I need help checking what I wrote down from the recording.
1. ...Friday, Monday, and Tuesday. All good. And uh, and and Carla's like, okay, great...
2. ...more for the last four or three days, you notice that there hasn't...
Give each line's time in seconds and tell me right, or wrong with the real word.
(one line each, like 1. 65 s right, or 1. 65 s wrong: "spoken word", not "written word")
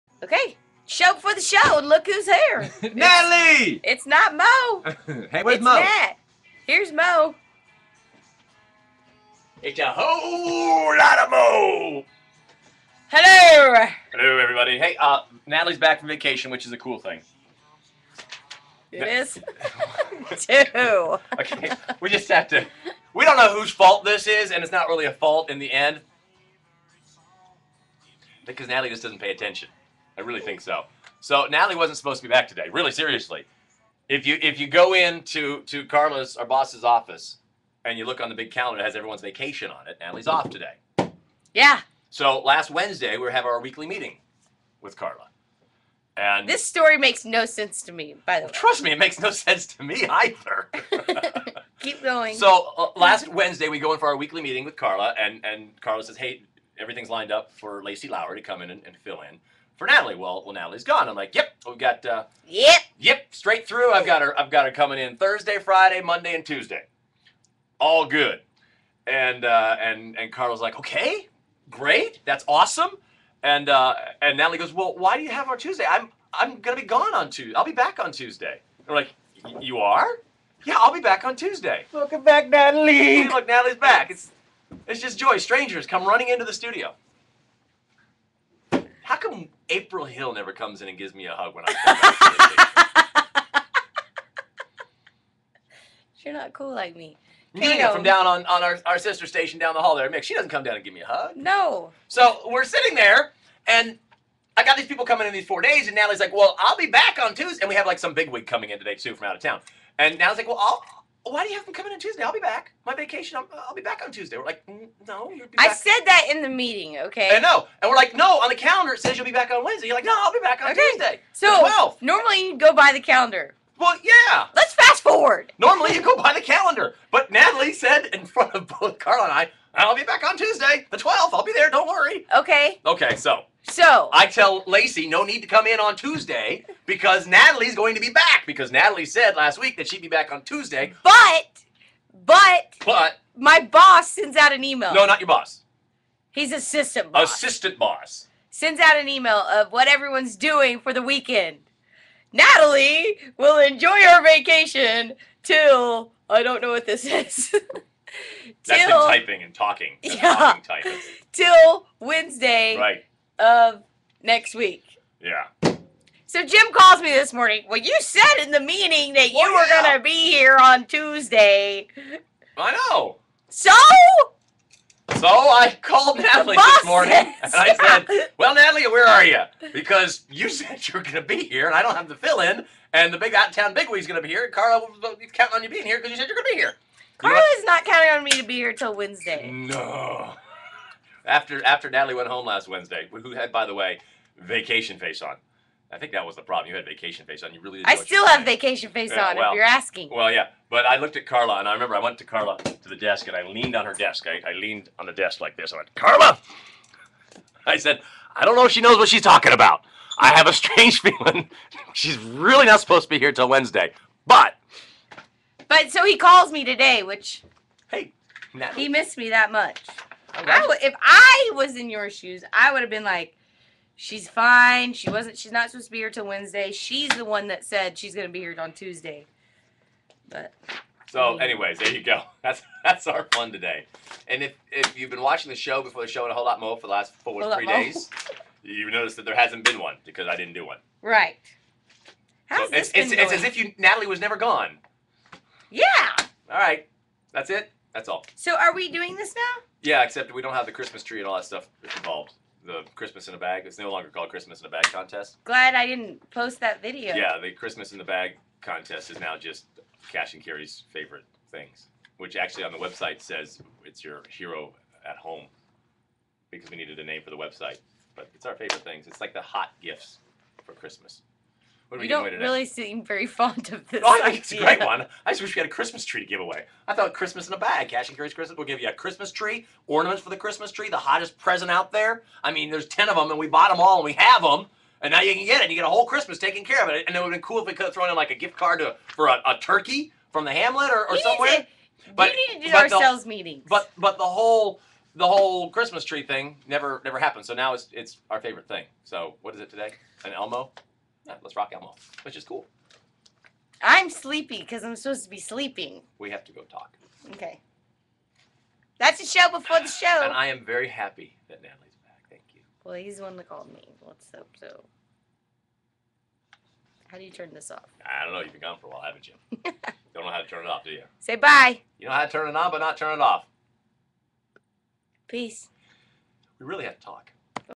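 1. 65 s right
2. 236 s right.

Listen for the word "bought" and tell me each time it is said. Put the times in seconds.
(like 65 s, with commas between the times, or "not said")
283 s.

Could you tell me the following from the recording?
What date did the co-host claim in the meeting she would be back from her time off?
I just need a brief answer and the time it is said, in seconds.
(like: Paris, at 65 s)
Tuesday the 12th, at 130 s.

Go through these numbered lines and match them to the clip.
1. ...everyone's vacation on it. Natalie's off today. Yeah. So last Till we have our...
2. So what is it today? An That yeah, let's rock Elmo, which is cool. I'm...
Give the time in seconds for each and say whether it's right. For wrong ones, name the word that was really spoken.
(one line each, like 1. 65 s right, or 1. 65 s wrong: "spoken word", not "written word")
1. 38 s wrong: "Wednesday", not "Till"
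2. 299 s wrong: "Elmo", not "That".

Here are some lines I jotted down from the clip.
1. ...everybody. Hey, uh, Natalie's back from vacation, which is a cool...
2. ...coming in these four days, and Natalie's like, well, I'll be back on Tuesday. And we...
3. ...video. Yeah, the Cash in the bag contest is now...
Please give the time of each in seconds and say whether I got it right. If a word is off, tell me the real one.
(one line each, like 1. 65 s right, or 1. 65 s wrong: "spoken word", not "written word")
1. 14 s right
2. 105 s right
3. 256 s wrong: "Christmas", not "Cash".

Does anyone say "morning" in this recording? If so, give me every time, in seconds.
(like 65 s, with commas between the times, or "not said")
167 s, 176 s.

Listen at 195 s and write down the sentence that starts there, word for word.
I think that was the problem.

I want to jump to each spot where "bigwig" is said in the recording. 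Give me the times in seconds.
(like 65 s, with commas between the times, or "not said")
108 s, 183 s.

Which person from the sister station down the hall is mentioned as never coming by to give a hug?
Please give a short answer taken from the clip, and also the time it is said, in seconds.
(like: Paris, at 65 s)
Nina Kano, at 97 s.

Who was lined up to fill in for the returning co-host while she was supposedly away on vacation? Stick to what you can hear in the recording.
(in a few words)
Lacey Lauer.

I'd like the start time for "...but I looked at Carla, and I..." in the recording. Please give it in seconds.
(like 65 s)
200 s.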